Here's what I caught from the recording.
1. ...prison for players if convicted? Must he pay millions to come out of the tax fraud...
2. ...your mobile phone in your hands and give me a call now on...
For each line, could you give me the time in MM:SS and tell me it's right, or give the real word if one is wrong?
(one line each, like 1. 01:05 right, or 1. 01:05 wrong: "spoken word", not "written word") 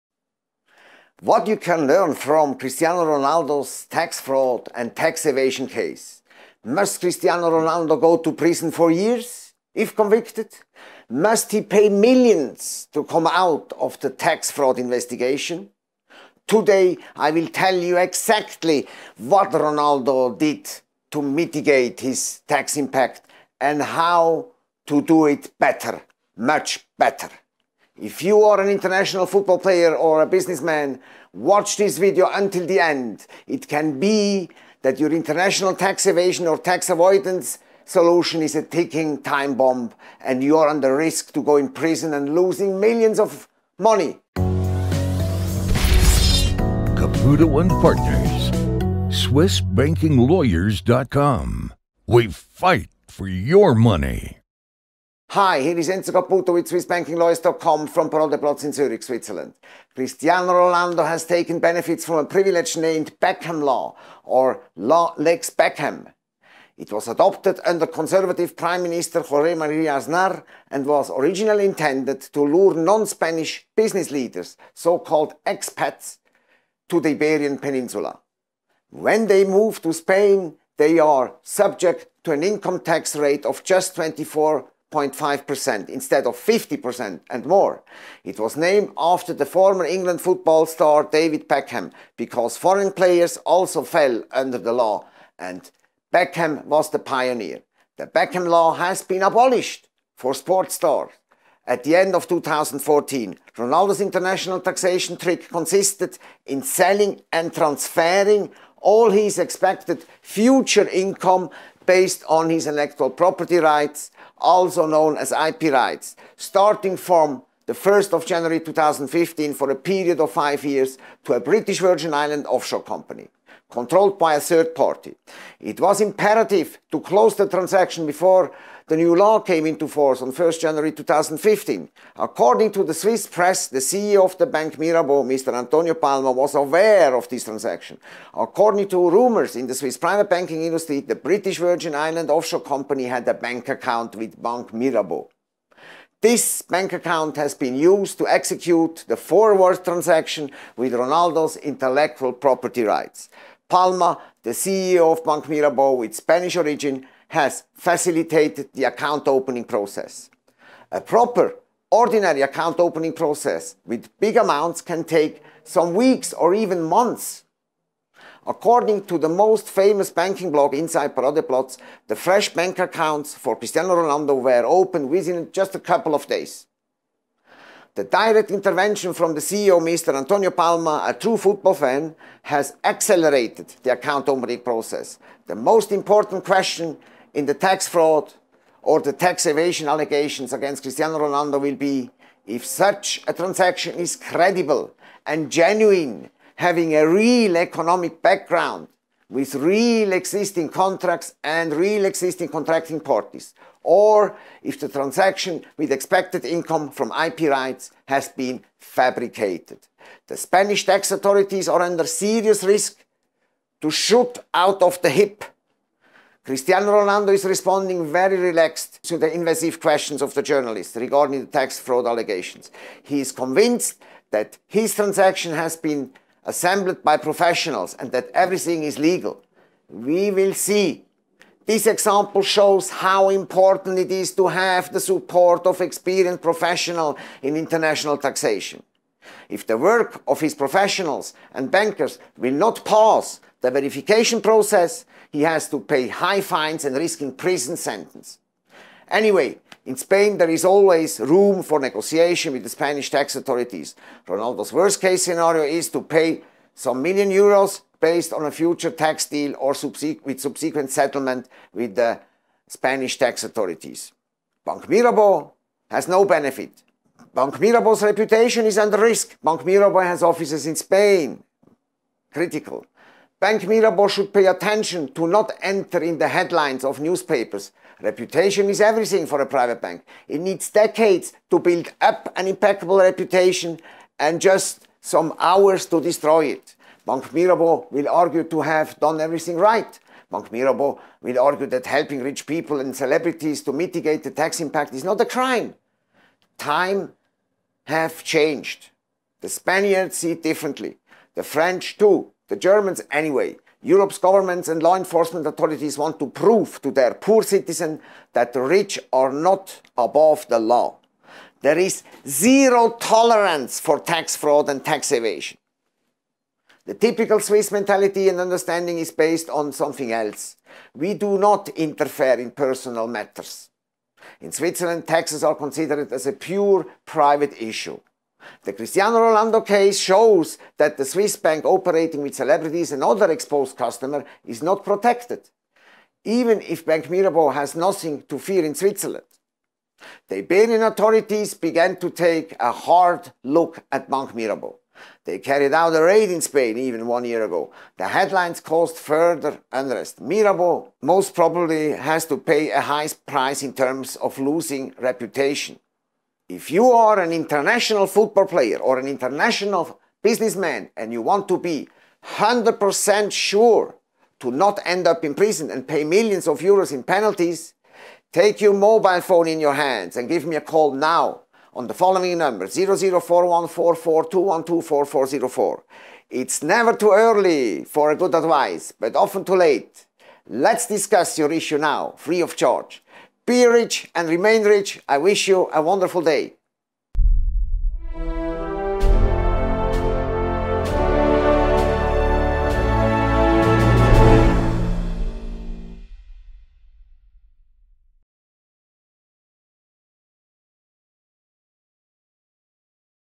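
1. 00:08 wrong: "years", not "players"
2. 06:08 right.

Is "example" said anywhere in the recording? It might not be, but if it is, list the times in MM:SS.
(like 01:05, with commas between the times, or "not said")
03:51.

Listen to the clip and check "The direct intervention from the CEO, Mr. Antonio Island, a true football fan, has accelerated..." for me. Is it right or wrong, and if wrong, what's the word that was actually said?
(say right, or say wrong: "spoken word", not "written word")
wrong: "Palma", not "Island".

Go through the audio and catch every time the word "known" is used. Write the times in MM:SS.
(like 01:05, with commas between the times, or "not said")
01:54.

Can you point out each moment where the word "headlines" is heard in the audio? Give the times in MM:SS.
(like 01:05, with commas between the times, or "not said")
04:36, 05:48.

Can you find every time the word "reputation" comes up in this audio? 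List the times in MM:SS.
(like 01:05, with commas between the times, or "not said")
04:28, 04:37, 04:42, 05:54.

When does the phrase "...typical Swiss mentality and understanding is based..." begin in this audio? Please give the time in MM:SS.
05:16.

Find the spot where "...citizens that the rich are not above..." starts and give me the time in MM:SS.
05:07.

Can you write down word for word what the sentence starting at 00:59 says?
Cristiano Rolando has taken benefits from a privilege named Beckham Law or Law Lex Beckham.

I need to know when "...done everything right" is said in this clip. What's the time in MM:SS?
04:48.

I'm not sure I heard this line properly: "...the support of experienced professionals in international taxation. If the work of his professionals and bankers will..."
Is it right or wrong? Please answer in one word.
right.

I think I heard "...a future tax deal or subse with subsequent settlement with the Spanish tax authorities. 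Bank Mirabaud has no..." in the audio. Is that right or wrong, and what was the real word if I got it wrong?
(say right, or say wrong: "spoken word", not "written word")
right.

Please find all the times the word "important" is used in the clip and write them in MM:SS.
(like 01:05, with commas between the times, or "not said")
03:05, 03:53.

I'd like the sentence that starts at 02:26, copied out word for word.
This bank account has been used to execute the forward transaction with Ronaldo's intellectual property rights.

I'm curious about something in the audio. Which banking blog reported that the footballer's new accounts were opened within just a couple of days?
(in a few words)
Inside Paradeplatz.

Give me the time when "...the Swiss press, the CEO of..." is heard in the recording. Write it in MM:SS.
02:12.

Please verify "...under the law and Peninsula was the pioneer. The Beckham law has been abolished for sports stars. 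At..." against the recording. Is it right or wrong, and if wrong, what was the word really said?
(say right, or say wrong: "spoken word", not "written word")
wrong: "Beckham", not "Peninsula".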